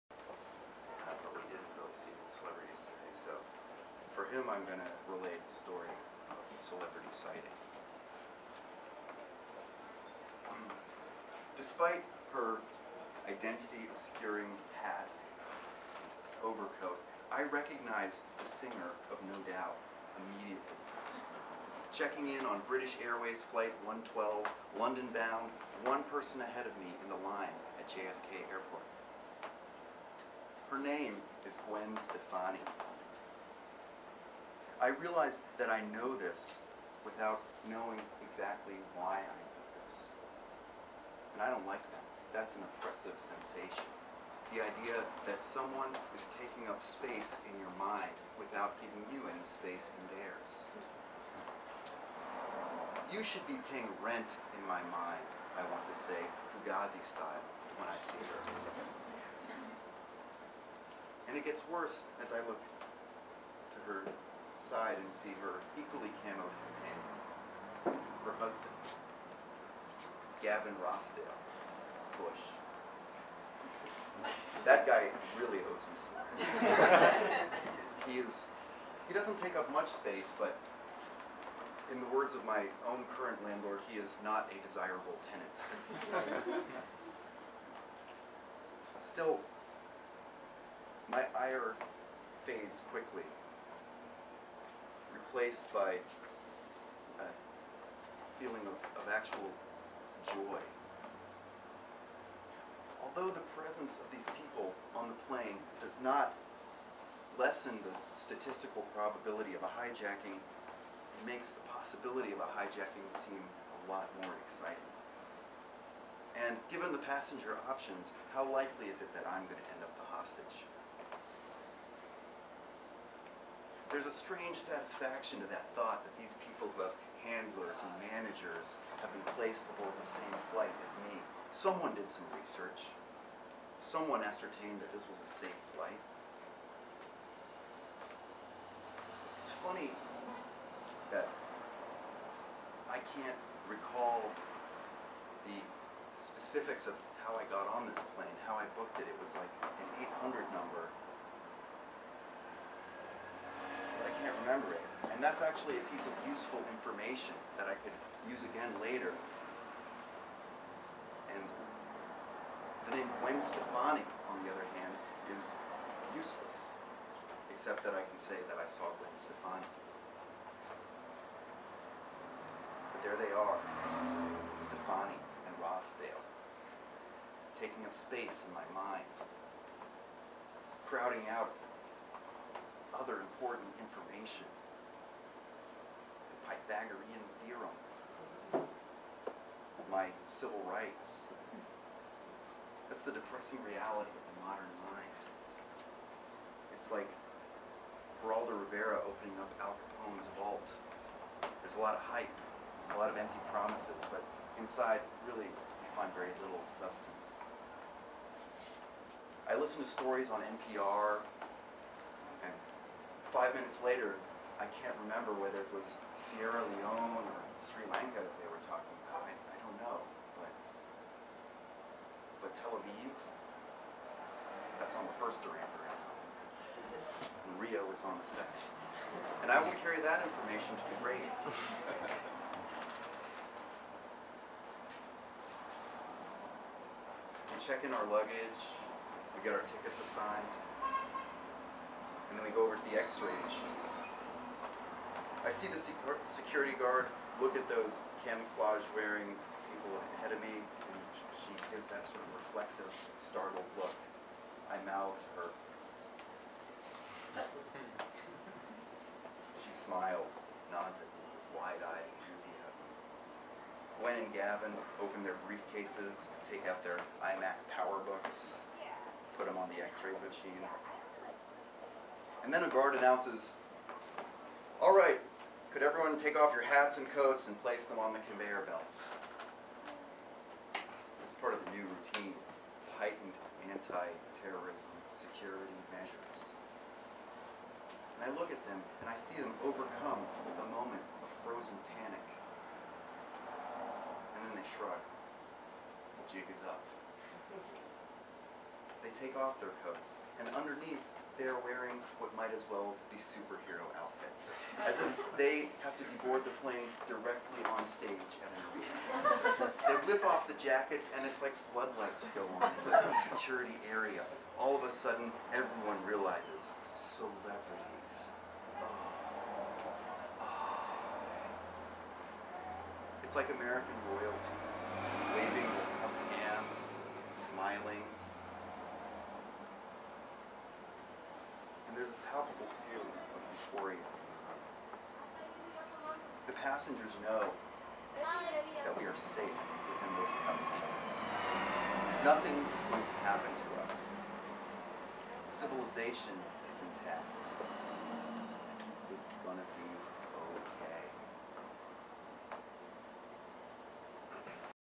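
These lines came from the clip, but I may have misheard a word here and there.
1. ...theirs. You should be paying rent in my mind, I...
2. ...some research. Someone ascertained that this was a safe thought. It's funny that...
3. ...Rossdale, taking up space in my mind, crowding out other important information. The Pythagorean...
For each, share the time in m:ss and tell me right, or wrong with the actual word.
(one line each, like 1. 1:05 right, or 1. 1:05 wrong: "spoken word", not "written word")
1. 0:50 right
2. 2:12 wrong: "flight", not "thought"
3. 2:55 right.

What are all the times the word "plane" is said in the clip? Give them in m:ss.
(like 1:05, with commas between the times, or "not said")
1:45, 2:28, 5:06.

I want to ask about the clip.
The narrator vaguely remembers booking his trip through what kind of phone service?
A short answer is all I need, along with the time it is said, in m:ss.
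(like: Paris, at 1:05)
800 number, at 2:30.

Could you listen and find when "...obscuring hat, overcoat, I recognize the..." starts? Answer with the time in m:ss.
0:13.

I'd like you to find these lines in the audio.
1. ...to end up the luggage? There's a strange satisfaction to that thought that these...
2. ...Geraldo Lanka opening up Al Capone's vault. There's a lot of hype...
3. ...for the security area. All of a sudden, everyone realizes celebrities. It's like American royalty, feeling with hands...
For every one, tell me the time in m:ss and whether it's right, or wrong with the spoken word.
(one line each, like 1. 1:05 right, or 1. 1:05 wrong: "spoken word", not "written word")
1. 1:59 wrong: "hostage", not "luggage"
2. 3:18 wrong: "Rivera", not "Lanka"
3. 5:12 wrong: "waving", not "feeling".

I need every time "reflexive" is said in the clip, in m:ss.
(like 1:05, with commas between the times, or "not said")
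4:12.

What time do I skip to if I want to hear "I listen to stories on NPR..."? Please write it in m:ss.
3:29.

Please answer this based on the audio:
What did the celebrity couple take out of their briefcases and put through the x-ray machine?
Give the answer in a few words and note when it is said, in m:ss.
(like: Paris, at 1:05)
iMac PowerBooks, at 4:27.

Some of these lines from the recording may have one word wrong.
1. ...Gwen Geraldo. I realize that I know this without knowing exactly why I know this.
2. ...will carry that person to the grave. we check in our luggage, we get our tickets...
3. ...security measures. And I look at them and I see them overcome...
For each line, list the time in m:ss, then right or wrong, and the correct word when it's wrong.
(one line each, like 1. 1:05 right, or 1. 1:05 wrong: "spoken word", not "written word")
1. 0:31 wrong: "Stefani", not "Geraldo"
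2. 3:49 wrong: "information", not "person"
3. 4:45 right.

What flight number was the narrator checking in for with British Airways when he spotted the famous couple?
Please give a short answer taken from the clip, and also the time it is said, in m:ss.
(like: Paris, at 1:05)
112, at 0:23.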